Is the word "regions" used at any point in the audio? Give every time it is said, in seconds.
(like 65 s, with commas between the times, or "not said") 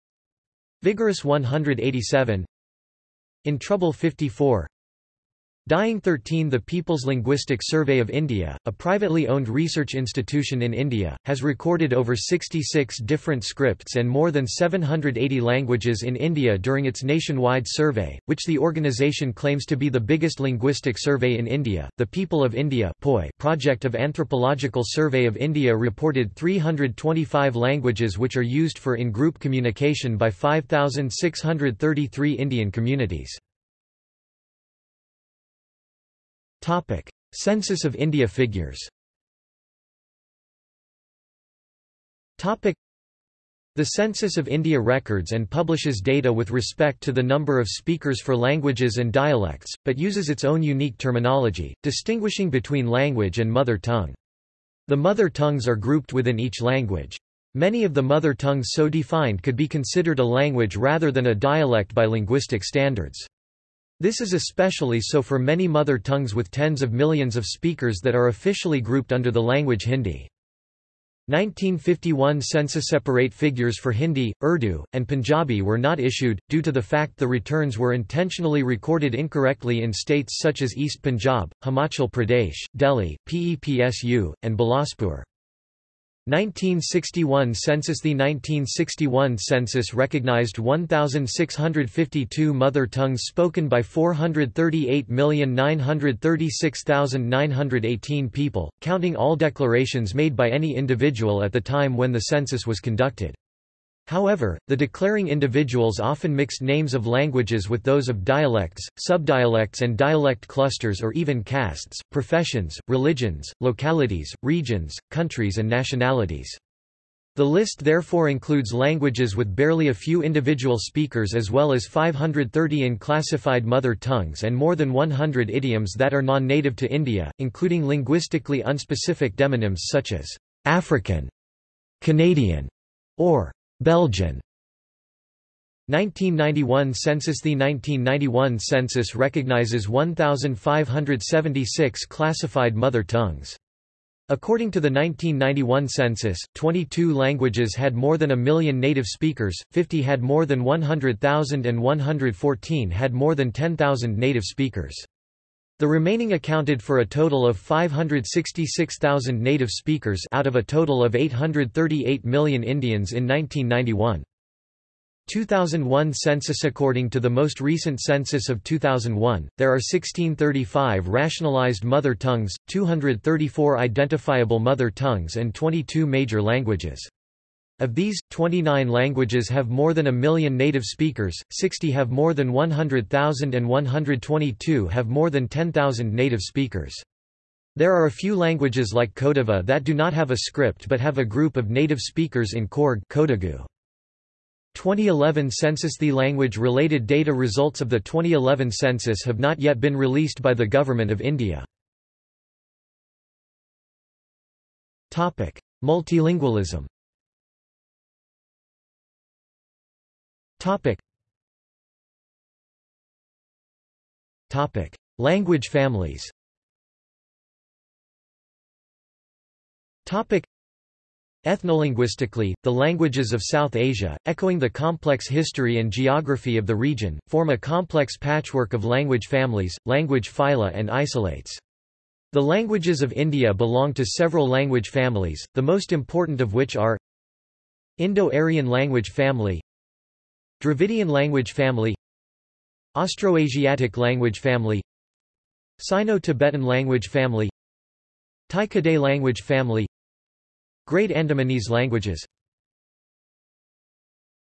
114 s, 226 s.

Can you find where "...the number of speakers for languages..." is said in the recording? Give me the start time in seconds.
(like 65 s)
47 s.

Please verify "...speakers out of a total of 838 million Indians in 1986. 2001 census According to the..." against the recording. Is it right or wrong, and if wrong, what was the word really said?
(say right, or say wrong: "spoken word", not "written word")
wrong: "1991", not "1986".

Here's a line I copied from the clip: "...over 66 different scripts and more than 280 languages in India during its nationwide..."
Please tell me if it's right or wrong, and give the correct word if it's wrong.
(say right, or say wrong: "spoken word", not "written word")
wrong: "780", not "280".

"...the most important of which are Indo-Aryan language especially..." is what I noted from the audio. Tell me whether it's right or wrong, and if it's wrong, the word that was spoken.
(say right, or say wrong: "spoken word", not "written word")
wrong: "family", not "especially".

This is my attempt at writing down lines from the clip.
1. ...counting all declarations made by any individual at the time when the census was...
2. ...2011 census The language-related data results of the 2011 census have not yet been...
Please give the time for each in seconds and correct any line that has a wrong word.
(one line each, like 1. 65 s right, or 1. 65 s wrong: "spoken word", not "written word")
1. 98 s right
2. 194 s right.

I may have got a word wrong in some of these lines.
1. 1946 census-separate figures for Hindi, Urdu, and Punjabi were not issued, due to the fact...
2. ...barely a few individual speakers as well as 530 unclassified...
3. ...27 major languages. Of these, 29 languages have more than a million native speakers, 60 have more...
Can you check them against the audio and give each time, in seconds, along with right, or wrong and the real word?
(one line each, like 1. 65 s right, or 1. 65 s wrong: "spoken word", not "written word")
1. 71 s wrong: "1951", not "1946"
2. 119 s right
3. 175 s wrong: "22", not "27".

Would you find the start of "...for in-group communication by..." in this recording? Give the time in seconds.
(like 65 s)
28 s.